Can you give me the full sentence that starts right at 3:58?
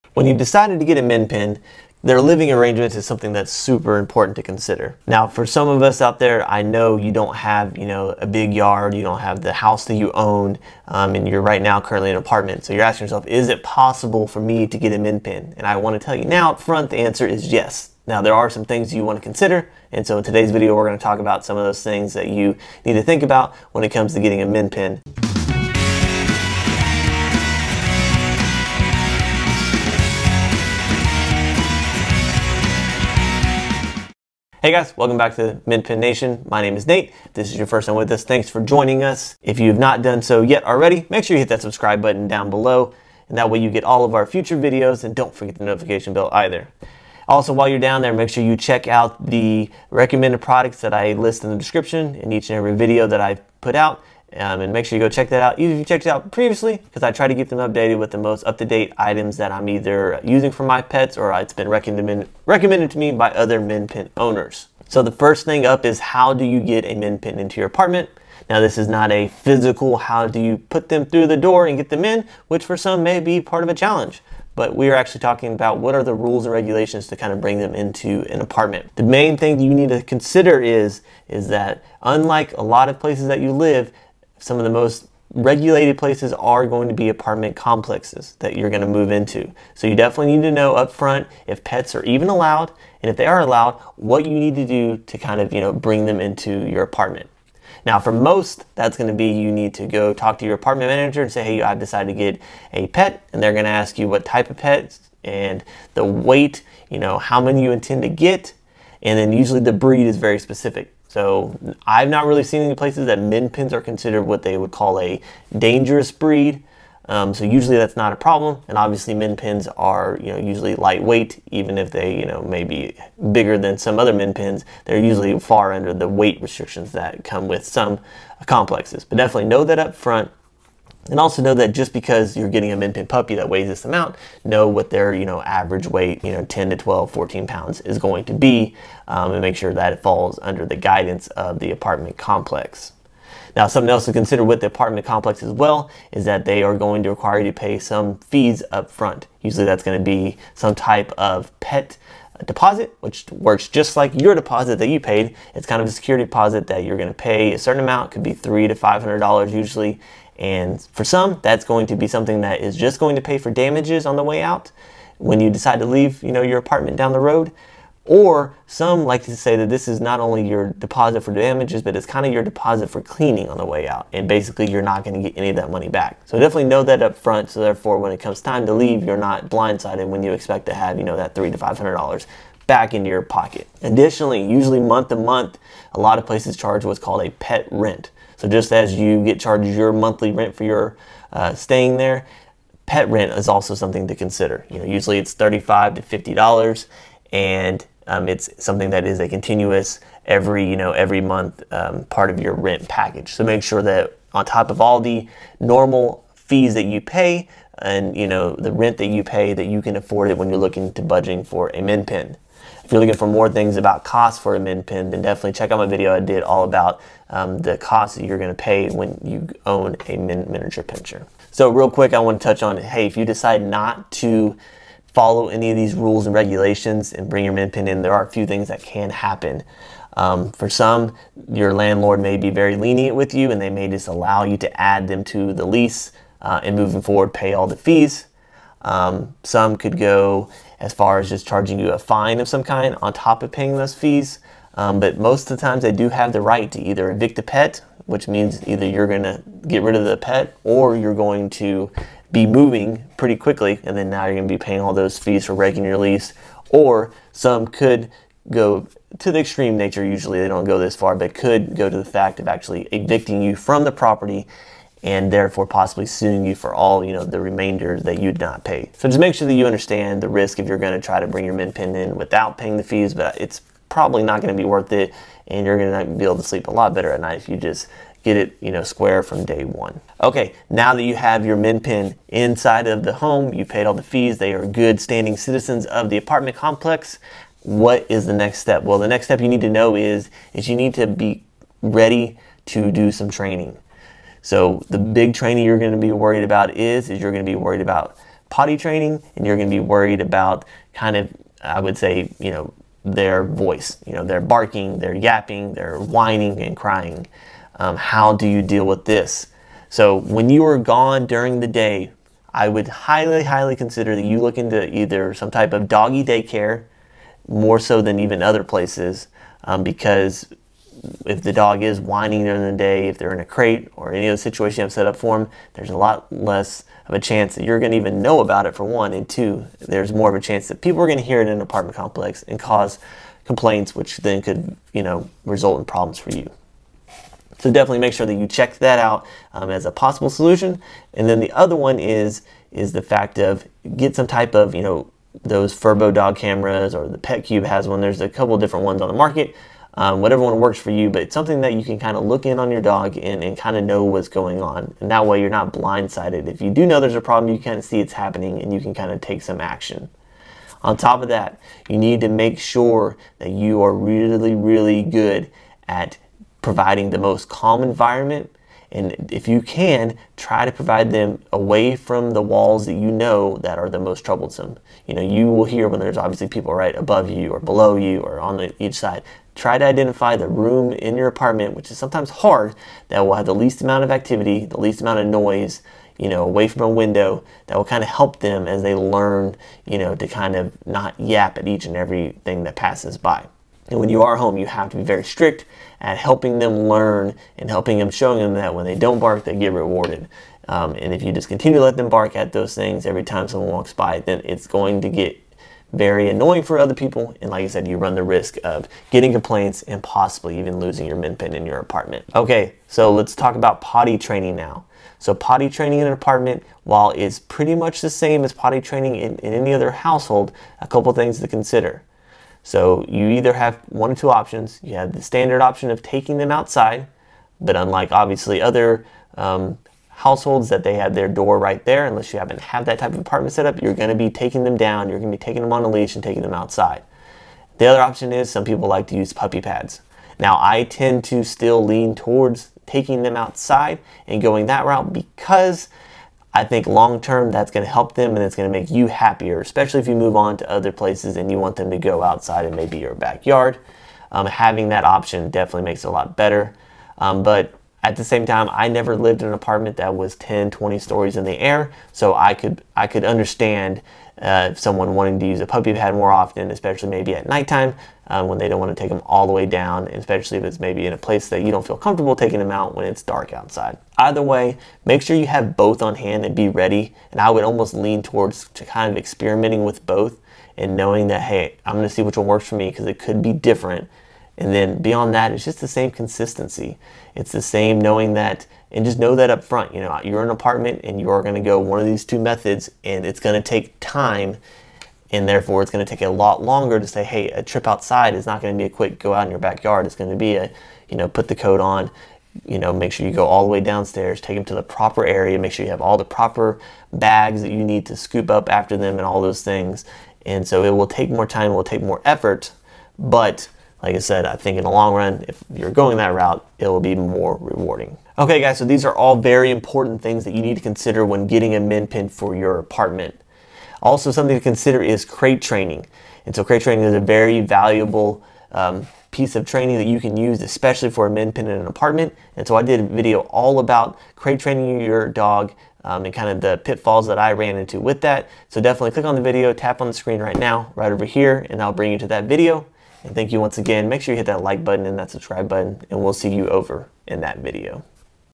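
Um, some could go as far as just charging you a fine of some kind on top of paying those fees.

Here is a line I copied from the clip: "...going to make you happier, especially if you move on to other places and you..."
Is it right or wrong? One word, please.
right.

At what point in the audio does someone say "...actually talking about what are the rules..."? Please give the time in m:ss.
1:14.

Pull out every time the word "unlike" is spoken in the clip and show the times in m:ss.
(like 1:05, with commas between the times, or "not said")
1:22, 7:07.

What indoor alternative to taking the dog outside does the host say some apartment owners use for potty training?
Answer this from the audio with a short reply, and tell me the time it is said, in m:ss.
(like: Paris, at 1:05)
puppy pads, at 7:19.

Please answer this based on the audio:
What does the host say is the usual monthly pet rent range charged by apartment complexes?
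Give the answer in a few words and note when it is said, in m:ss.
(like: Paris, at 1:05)
$35 to $50, at 3:15.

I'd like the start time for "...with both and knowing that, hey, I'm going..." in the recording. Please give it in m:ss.
7:59.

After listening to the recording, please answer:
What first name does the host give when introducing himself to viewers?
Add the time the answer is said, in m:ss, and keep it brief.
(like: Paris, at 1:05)
Nate, at 0:36.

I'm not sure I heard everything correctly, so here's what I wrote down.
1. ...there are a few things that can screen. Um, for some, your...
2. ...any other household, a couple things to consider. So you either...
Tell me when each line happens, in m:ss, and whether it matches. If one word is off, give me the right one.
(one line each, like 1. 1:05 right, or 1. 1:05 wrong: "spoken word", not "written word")
1. 3:48 wrong: "happen", not "screen"
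2. 6:59 right.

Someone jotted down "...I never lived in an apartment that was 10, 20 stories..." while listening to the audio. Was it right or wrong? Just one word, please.
right.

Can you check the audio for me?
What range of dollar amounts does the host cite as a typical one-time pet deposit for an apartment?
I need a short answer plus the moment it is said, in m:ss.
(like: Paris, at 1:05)
$300 to $500, at 2:38.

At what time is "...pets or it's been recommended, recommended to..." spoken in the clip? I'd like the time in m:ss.
1:00.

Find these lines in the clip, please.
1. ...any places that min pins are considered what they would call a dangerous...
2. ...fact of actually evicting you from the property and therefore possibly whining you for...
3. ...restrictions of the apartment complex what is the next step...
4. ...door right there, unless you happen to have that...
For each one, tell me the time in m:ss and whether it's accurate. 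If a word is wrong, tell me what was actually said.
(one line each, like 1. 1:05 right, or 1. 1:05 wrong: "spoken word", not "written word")
1. 1:52 right
2. 4:22 wrong: "suing", not "whining"
3. 4:45 wrong: "citizens", not "restrictions"
4. 7:11 right.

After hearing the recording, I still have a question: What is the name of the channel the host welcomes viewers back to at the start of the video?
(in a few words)
Min Pin Nation.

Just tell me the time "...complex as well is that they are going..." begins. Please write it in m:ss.
2:25.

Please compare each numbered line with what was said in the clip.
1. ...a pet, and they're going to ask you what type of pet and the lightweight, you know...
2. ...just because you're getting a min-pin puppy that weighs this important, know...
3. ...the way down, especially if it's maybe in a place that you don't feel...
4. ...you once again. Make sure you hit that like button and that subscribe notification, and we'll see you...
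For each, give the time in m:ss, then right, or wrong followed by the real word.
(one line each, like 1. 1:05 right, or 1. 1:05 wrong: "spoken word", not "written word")
1. 1:42 wrong: "weight", not "lightweight"
2. 2:11 wrong: "amount", not "important"
3. 7:49 right
4. 9:03 wrong: "button", not "notification".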